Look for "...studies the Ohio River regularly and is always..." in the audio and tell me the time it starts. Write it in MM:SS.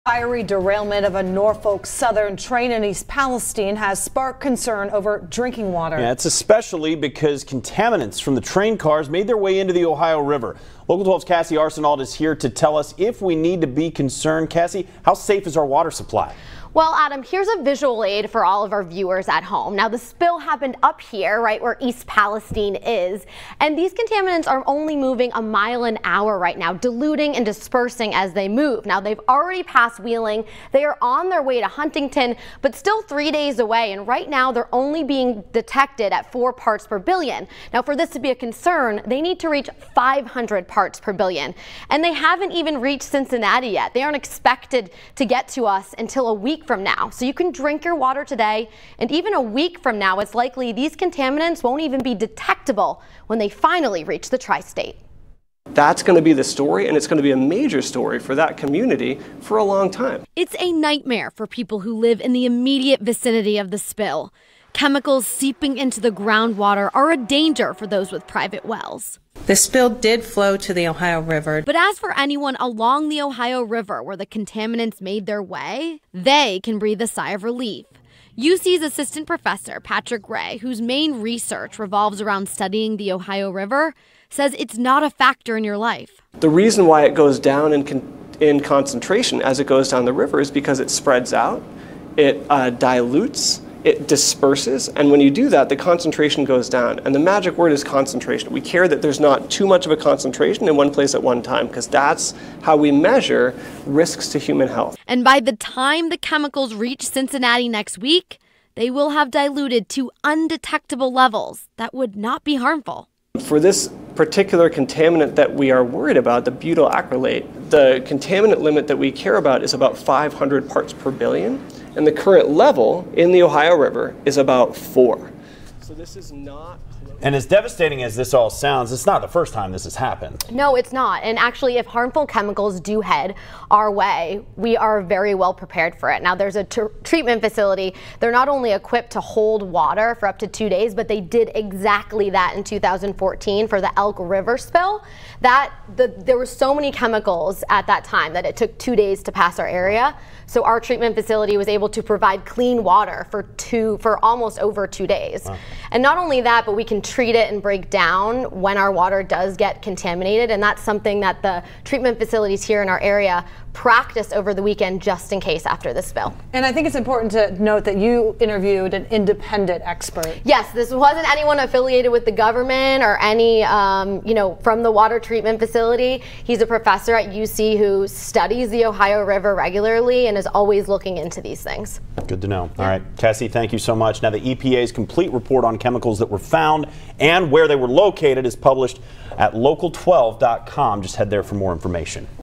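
02:58.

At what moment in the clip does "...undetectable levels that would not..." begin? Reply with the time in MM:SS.
01:50.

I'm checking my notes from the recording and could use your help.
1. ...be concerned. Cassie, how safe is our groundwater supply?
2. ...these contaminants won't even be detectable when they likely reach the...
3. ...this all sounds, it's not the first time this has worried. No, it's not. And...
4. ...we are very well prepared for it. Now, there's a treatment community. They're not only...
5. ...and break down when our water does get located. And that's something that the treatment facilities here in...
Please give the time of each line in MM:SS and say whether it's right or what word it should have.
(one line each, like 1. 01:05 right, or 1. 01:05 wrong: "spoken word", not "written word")
1. 00:13 wrong: "water", not "groundwater"
2. 00:50 wrong: "finally", not "likely"
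3. 02:08 wrong: "happened", not "worried"
4. 02:14 wrong: "facility", not "community"
5. 02:37 wrong: "contaminated", not "located".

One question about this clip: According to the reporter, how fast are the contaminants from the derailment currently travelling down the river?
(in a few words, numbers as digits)
1 mile an hour.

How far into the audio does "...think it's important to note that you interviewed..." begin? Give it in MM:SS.
02:46.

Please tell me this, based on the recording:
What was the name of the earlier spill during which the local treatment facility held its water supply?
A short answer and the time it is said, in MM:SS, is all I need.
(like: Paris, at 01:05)
Elk River spill, at 02:23.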